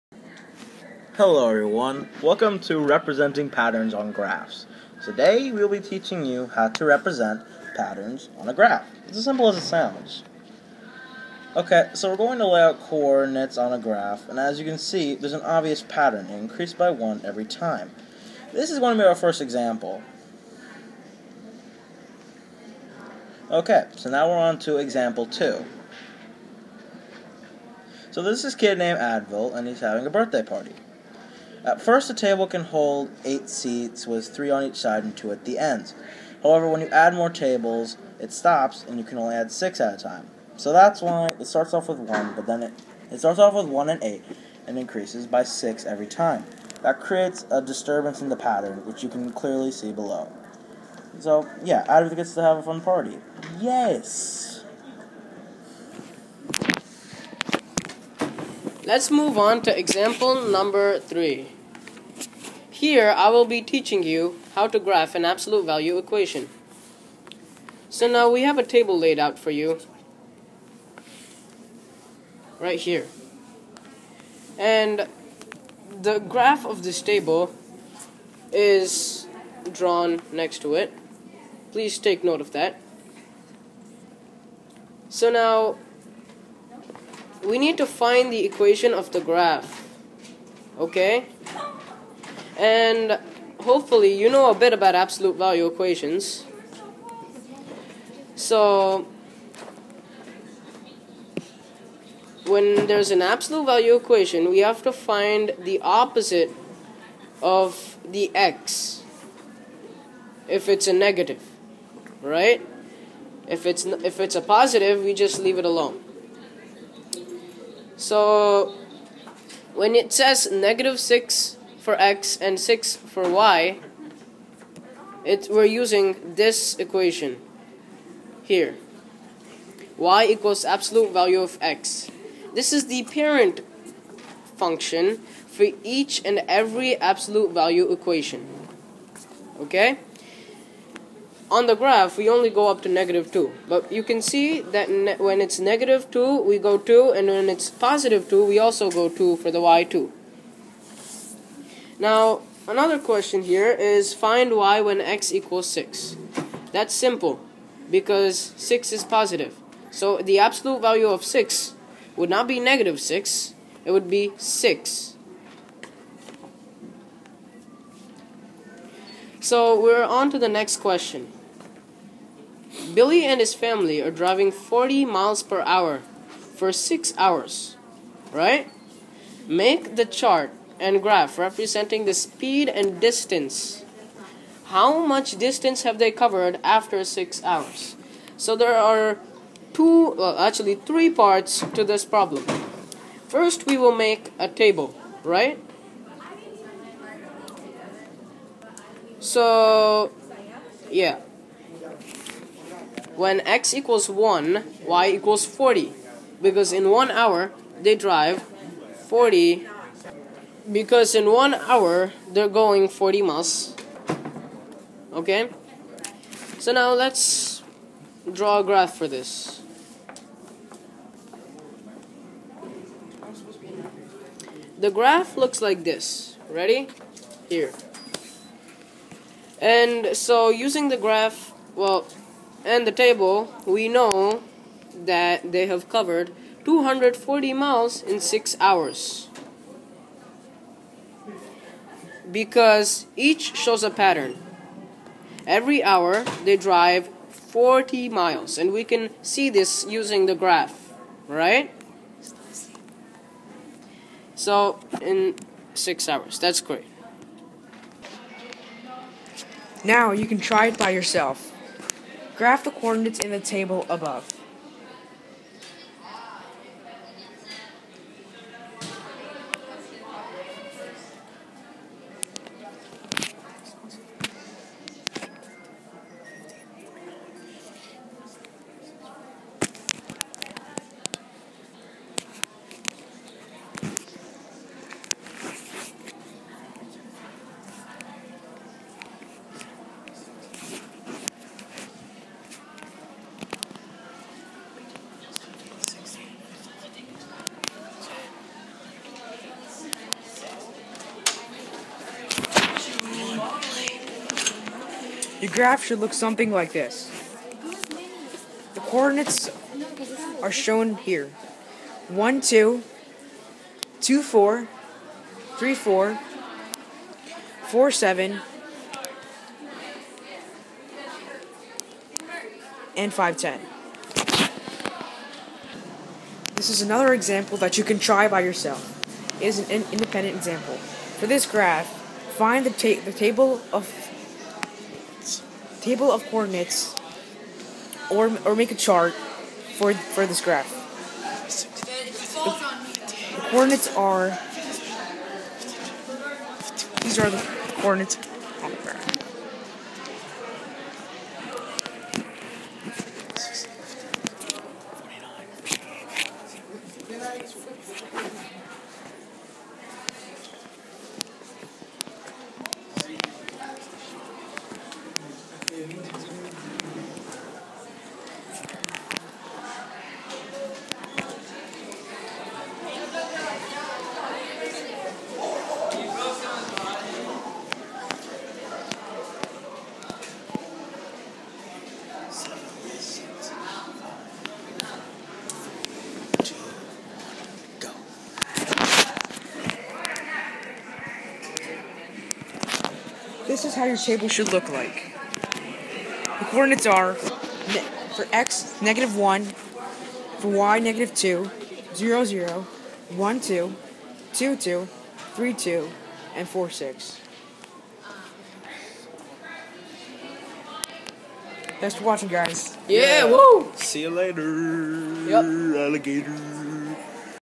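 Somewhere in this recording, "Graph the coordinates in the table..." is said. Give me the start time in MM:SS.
04:22.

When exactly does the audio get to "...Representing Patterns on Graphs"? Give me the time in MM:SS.
00:02.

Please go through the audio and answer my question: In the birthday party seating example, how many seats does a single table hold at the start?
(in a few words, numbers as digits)
8.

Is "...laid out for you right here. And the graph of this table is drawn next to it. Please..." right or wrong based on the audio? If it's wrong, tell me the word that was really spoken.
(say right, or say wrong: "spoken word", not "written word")
right.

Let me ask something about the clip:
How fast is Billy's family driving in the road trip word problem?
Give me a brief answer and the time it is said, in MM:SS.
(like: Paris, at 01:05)
40 miles per hour, at 02:54.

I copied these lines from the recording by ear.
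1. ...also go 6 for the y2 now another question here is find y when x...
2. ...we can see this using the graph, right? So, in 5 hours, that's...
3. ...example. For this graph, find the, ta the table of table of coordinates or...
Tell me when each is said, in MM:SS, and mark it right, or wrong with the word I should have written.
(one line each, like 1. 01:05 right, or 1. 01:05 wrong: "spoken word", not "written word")
1. 02:28 wrong: "2", not "6"
2. 04:08 wrong: "6", not "5"
3. 05:30 right.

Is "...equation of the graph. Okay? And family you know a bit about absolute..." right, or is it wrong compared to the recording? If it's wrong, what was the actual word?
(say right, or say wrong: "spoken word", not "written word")
wrong: "hopefully", not "family".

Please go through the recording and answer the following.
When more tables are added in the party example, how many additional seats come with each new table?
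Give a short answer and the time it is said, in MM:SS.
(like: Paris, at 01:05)
6, at 00:39.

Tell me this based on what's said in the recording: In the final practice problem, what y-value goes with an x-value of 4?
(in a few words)
6.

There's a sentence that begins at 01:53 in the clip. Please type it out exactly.
If it's if it's a positive, we just leave it alone.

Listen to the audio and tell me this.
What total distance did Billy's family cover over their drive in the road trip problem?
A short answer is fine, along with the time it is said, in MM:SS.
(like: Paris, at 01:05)
240 miles, at 03:56.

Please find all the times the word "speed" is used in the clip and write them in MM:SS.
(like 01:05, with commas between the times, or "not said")
03:02.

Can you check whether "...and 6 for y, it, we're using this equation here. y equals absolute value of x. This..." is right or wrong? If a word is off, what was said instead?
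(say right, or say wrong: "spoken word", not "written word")
right.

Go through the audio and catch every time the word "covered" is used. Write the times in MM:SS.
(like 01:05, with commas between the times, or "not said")
03:06, 03:55.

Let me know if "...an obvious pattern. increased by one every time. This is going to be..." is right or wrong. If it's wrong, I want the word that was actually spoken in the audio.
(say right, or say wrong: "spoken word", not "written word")
right.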